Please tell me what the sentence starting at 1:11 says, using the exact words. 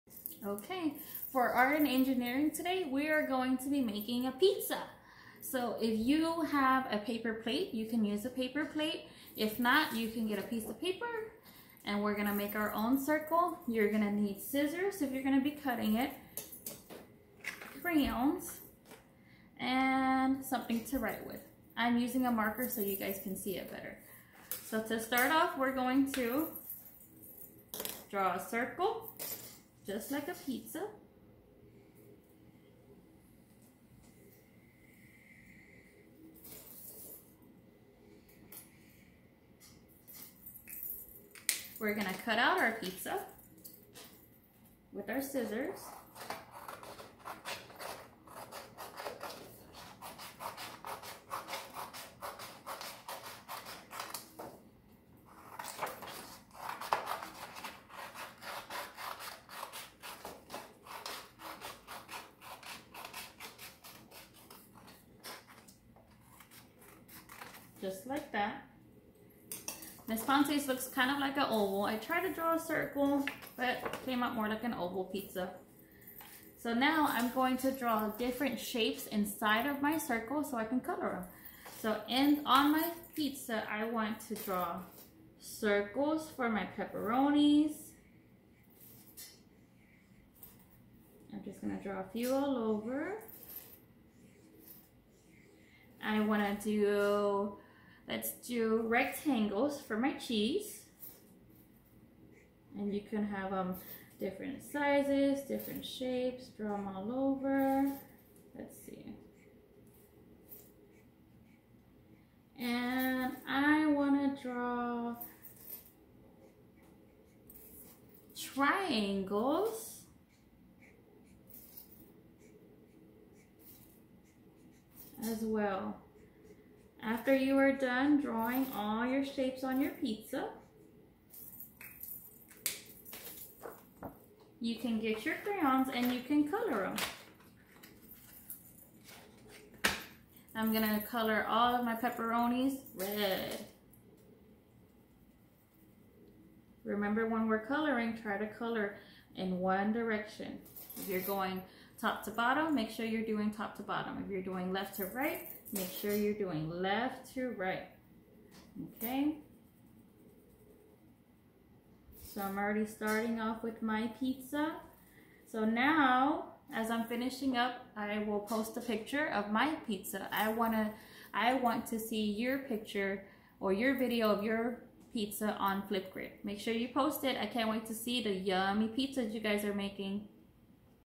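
I tried to draw a circle, but came out more like an oval pizza.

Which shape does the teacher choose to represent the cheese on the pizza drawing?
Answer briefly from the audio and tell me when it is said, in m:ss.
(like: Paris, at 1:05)
rectangles, at 1:38.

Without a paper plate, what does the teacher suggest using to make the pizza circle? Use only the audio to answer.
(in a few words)
a piece of paper.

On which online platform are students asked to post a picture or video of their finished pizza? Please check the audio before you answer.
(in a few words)
Flipgrid.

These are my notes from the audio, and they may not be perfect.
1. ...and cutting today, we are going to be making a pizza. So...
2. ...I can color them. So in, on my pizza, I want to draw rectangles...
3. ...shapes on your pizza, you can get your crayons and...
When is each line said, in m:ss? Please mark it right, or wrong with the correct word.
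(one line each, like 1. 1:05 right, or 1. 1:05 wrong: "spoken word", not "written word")
1. 0:01 wrong: "engineering", not "cutting"
2. 1:20 wrong: "circles", not "rectangles"
3. 2:09 right.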